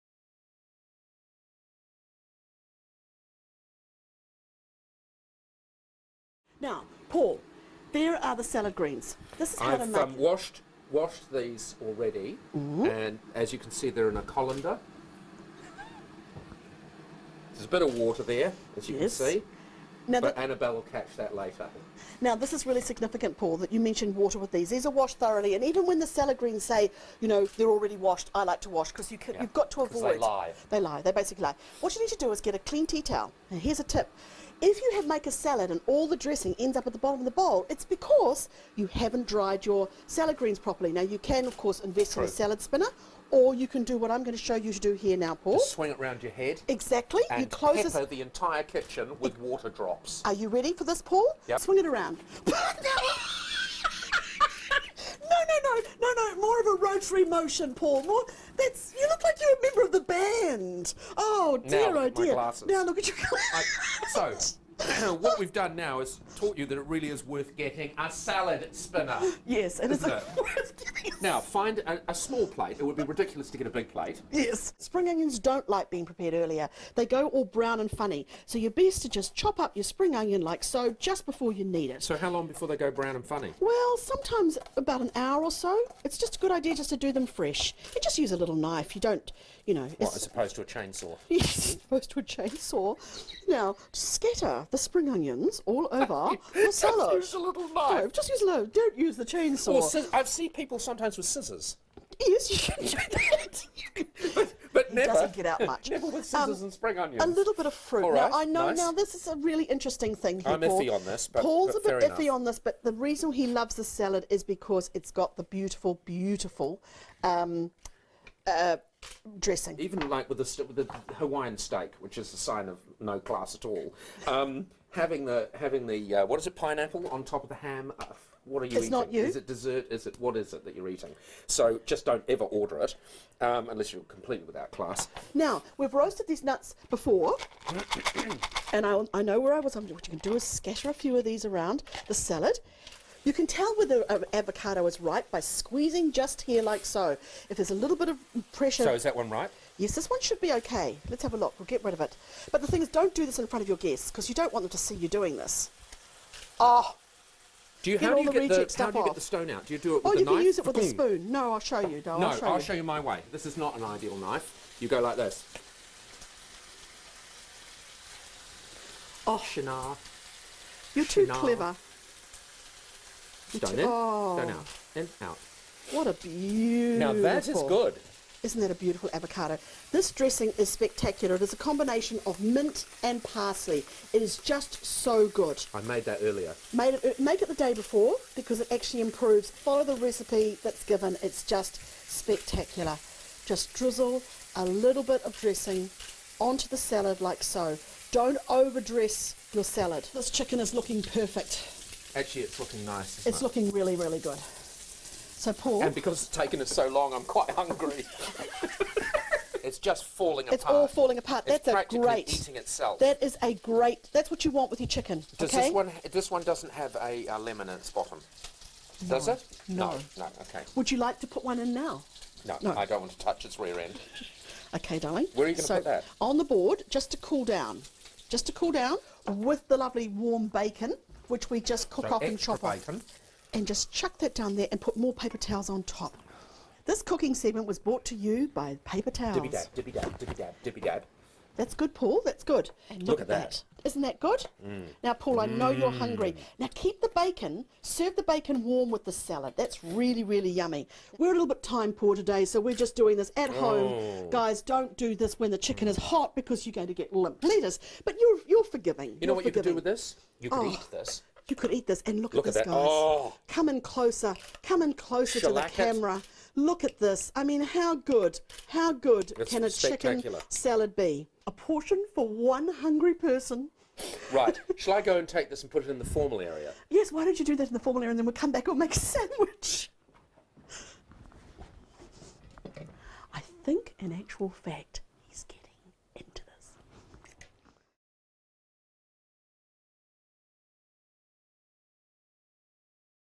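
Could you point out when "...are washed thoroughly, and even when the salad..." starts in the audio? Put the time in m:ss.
0:24.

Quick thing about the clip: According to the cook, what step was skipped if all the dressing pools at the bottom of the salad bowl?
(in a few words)
Dried your salad greens.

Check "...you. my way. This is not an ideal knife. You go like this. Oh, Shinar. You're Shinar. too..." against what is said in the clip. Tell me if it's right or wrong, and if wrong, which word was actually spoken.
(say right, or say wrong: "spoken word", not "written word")
right.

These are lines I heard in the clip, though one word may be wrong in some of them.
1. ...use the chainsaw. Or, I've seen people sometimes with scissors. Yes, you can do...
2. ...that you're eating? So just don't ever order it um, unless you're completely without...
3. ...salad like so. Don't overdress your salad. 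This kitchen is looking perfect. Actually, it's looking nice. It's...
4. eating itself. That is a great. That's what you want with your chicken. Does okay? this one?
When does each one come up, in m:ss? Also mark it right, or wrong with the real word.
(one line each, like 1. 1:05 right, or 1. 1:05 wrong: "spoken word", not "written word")
1. 1:38 right
2. 2:10 right
3. 3:16 wrong: "chicken", not "kitchen"
4. 3:32 right.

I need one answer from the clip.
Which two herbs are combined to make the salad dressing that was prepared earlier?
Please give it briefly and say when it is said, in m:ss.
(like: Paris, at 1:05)
Mint and parsley, at 3:02.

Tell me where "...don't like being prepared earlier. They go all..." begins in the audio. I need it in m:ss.
1:15.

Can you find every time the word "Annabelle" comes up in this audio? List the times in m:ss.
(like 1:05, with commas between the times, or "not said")
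0:20.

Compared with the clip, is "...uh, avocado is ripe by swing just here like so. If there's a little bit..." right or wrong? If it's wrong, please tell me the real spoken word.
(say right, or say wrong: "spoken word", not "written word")
wrong: "squeezing", not "swing".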